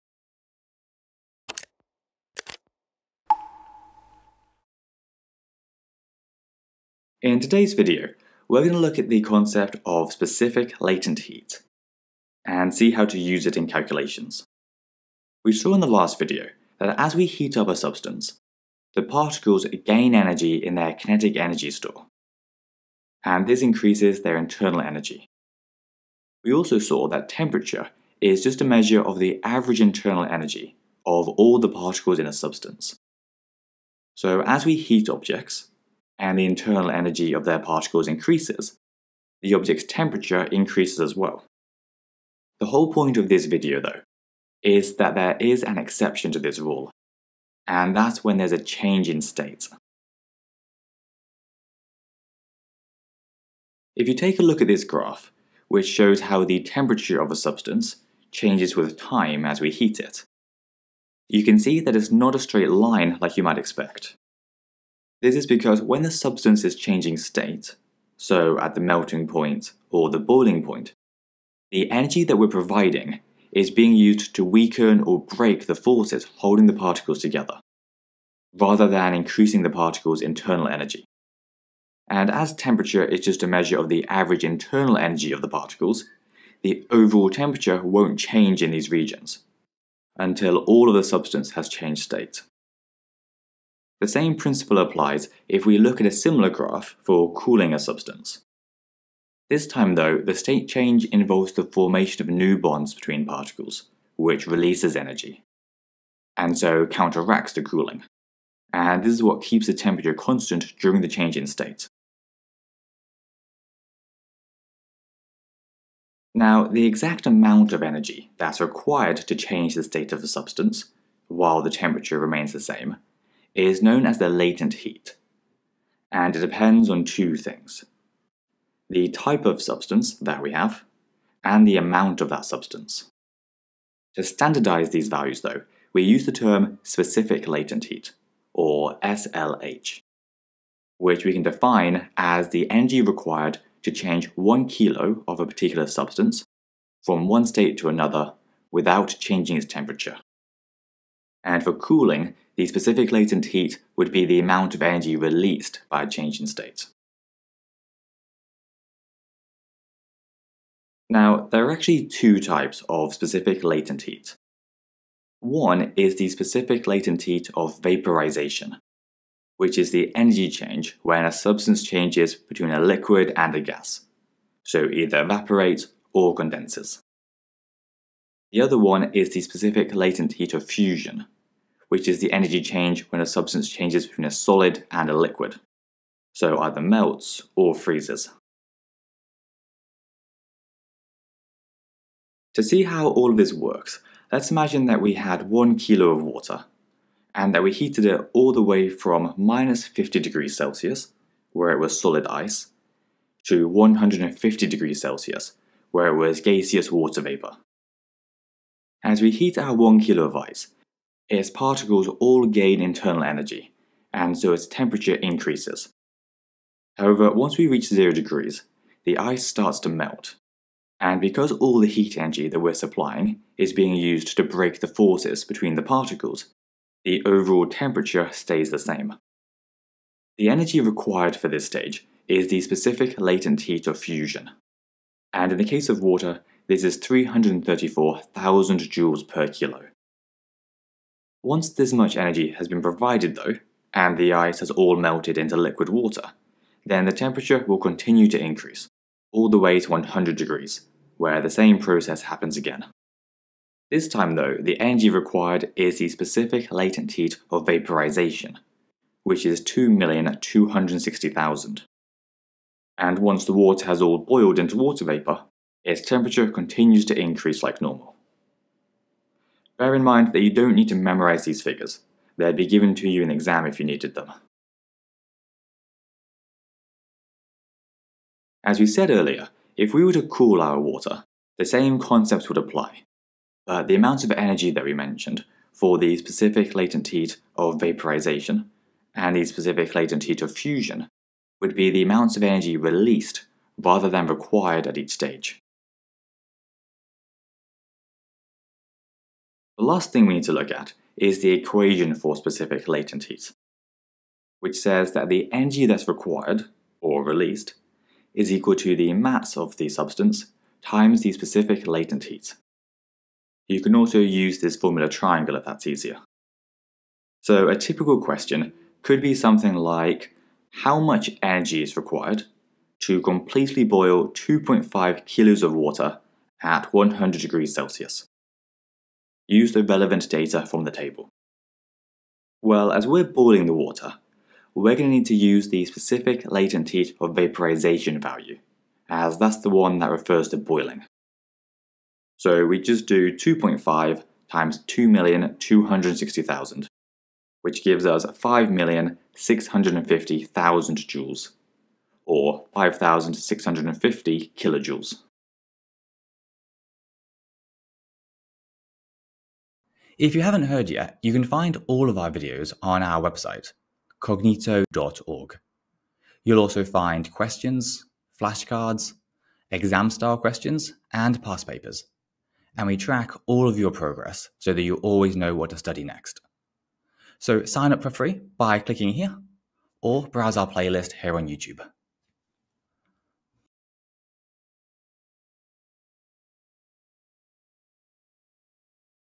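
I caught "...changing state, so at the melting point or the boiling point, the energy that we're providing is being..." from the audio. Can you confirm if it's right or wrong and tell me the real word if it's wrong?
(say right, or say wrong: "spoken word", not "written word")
right.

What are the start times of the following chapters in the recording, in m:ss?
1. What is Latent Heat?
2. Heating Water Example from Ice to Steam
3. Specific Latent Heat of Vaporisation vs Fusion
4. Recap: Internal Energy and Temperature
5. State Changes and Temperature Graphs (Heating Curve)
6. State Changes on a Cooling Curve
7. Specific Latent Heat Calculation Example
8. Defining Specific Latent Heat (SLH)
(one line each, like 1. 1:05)
1. 1:55
2. 3:12
3. 2:41
4. 0:15
5. 0:53
6. 1:34
7. 5:17
8. 2:14.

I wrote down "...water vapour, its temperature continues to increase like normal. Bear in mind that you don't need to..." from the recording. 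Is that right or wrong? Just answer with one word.
right.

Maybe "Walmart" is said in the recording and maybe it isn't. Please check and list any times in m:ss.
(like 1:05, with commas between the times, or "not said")
not said.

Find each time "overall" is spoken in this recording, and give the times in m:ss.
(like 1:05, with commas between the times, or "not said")
1:26, 3:47.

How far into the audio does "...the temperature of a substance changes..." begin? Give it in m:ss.
0:56.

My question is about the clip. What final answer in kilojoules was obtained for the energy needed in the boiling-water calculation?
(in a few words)
5,650 kilojoules.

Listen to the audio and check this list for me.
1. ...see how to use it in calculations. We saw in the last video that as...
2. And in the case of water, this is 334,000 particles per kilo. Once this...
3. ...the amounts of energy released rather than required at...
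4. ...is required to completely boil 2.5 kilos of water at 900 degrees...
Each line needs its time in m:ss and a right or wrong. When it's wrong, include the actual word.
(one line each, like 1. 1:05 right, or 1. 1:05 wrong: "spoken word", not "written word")
1. 0:12 right
2. 3:55 wrong: "joules", not "particles"
3. 4:51 right
4. 5:21 wrong: "100", not "900".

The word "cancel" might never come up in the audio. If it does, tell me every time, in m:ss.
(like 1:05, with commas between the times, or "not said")
not said.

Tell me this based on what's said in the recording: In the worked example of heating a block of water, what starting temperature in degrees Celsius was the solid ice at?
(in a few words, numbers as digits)
-50.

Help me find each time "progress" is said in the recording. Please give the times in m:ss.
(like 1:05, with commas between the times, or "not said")
6:13.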